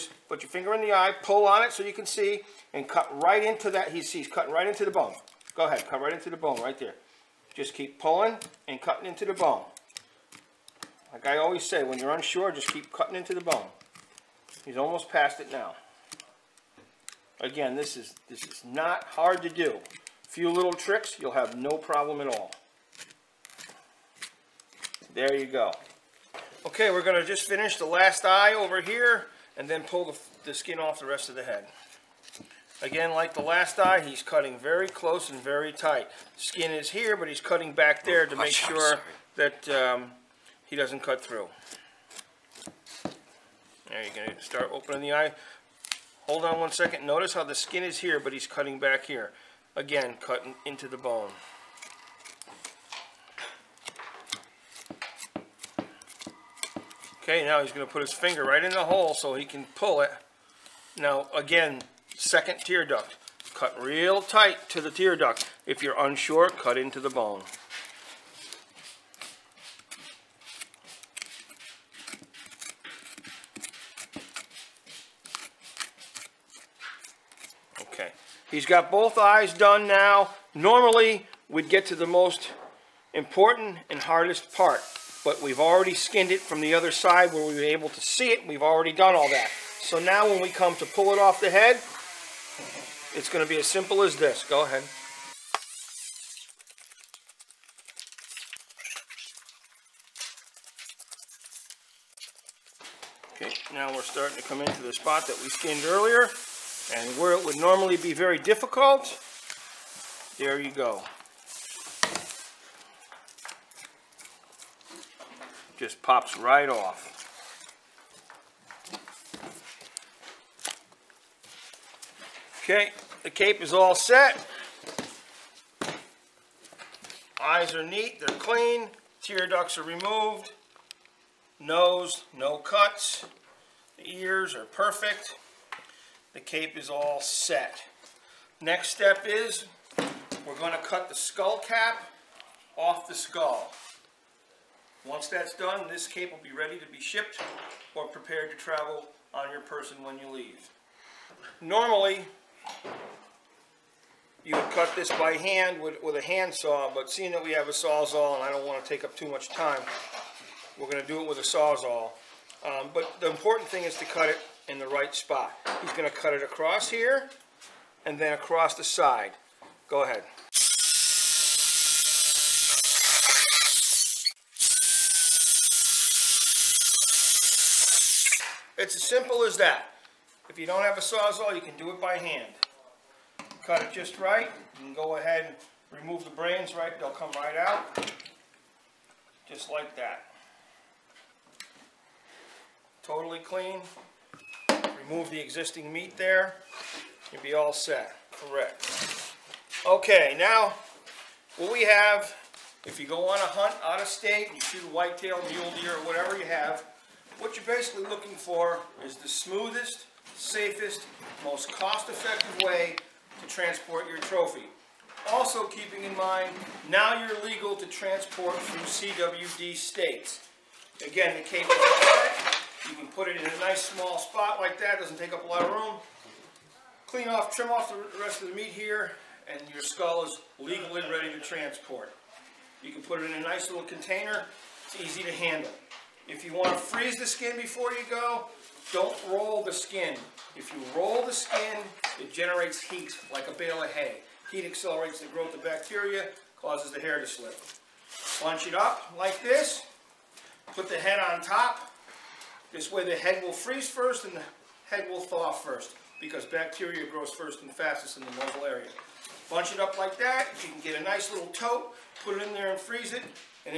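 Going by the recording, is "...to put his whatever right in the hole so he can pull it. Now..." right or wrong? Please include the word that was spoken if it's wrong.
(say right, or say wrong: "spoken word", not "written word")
wrong: "finger", not "whatever".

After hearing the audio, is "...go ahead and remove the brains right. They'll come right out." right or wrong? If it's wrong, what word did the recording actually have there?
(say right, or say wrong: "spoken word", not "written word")
right.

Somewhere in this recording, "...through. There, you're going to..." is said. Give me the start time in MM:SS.
00:41.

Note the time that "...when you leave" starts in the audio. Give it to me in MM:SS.
02:30.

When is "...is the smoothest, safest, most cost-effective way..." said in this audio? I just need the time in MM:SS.
03:29.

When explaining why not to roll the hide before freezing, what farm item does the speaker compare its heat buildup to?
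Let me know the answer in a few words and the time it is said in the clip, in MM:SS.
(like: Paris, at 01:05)
A bale of hay, at 04:03.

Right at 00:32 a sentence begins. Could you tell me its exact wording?
Again, like the last eye, he's cutting very close and very tight.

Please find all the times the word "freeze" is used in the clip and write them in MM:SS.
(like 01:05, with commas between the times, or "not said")
03:56, 04:13, 04:22.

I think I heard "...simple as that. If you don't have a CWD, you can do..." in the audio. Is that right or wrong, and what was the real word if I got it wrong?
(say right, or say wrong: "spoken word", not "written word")
wrong: "Sawzall", not "CWD".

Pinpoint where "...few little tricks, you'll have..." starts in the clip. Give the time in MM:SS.
00:20.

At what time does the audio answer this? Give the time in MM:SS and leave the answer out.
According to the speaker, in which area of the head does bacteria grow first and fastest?
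04:18.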